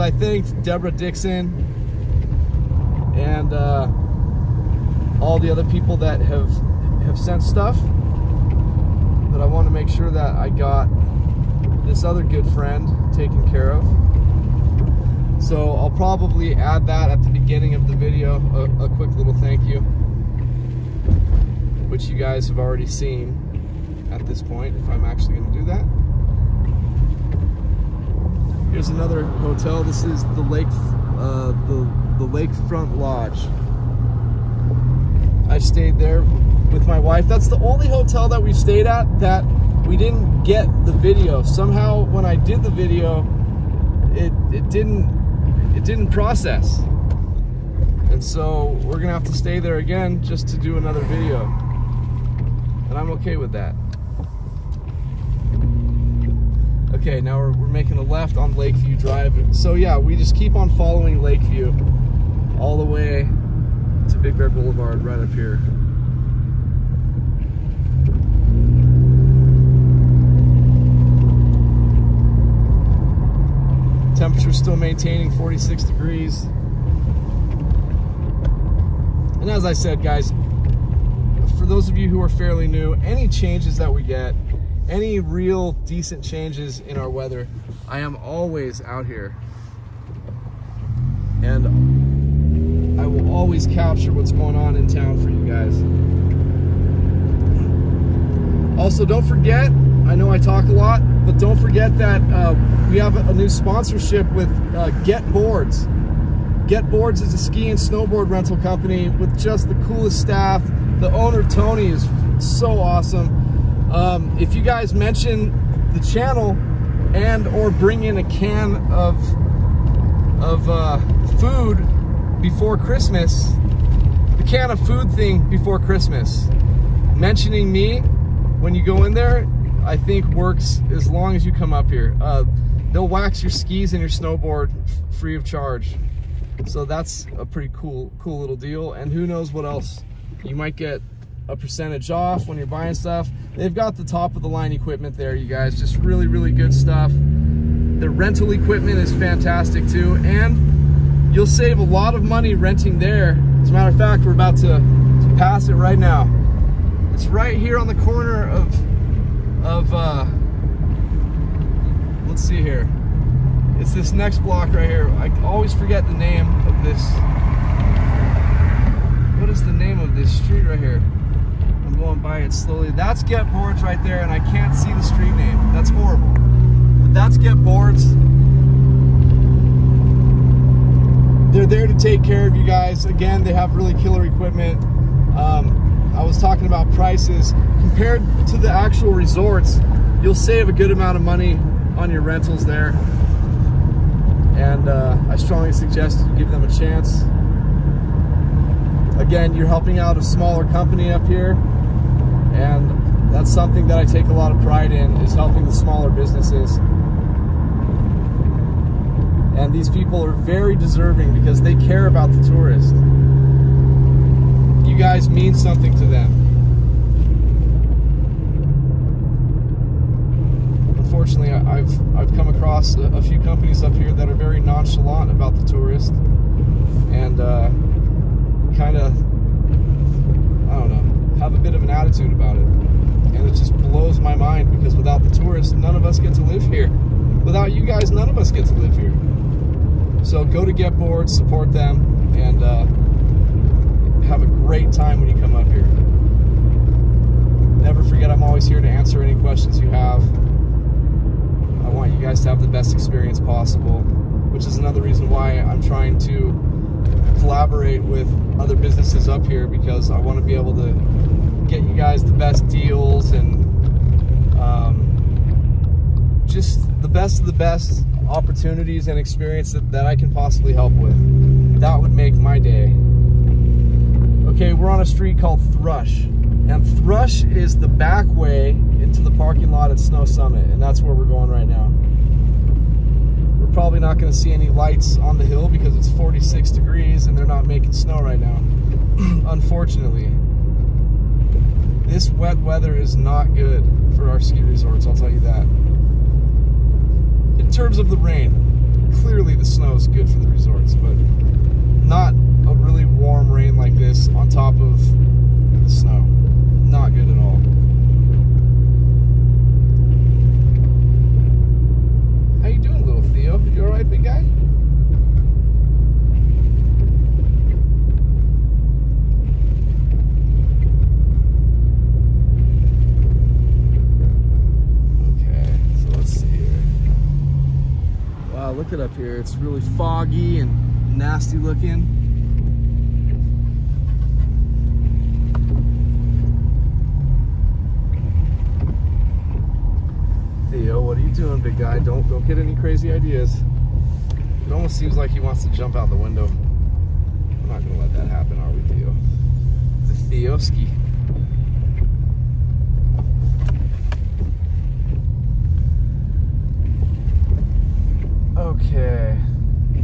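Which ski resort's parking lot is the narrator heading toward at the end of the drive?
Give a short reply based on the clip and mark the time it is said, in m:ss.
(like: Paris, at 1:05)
Snow Summit, at 4:39.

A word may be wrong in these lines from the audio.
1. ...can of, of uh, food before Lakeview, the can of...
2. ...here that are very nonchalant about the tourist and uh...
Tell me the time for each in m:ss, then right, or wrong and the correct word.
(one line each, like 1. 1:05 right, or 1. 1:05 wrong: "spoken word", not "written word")
1. 1:58 wrong: "Christmas", not "Lakeview"
2. 3:43 right.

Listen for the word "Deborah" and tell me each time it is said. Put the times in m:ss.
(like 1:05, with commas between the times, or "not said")
0:00.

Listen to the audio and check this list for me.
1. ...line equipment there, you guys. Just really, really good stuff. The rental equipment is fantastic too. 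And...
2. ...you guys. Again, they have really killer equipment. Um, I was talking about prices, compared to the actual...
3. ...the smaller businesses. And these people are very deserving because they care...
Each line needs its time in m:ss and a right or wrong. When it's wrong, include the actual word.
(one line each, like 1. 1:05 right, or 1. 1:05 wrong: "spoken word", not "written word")
1. 2:24 right
2. 3:02 right
3. 3:25 right.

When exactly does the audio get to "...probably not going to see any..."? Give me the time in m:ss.
4:43.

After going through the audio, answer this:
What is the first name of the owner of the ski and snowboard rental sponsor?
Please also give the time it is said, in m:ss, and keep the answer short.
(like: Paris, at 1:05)
Tony, at 1:51.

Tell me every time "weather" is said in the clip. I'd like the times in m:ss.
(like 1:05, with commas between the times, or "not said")
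1:27, 4:52.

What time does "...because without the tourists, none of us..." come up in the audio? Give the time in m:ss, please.
3:54.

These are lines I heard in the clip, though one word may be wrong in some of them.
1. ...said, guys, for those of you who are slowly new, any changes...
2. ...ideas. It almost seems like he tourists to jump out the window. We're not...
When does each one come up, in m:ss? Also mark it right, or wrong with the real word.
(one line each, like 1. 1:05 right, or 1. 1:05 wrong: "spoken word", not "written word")
1. 1:19 wrong: "fairly", not "slowly"
2. 5:43 wrong: "wants", not "tourists".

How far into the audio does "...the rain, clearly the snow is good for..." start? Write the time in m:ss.
4:58.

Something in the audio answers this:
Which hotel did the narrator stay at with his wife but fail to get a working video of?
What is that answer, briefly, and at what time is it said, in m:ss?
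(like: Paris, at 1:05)
Lakefront Lodge, at 0:32.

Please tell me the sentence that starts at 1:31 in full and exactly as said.
And I will always capture what's going on in town for you guys.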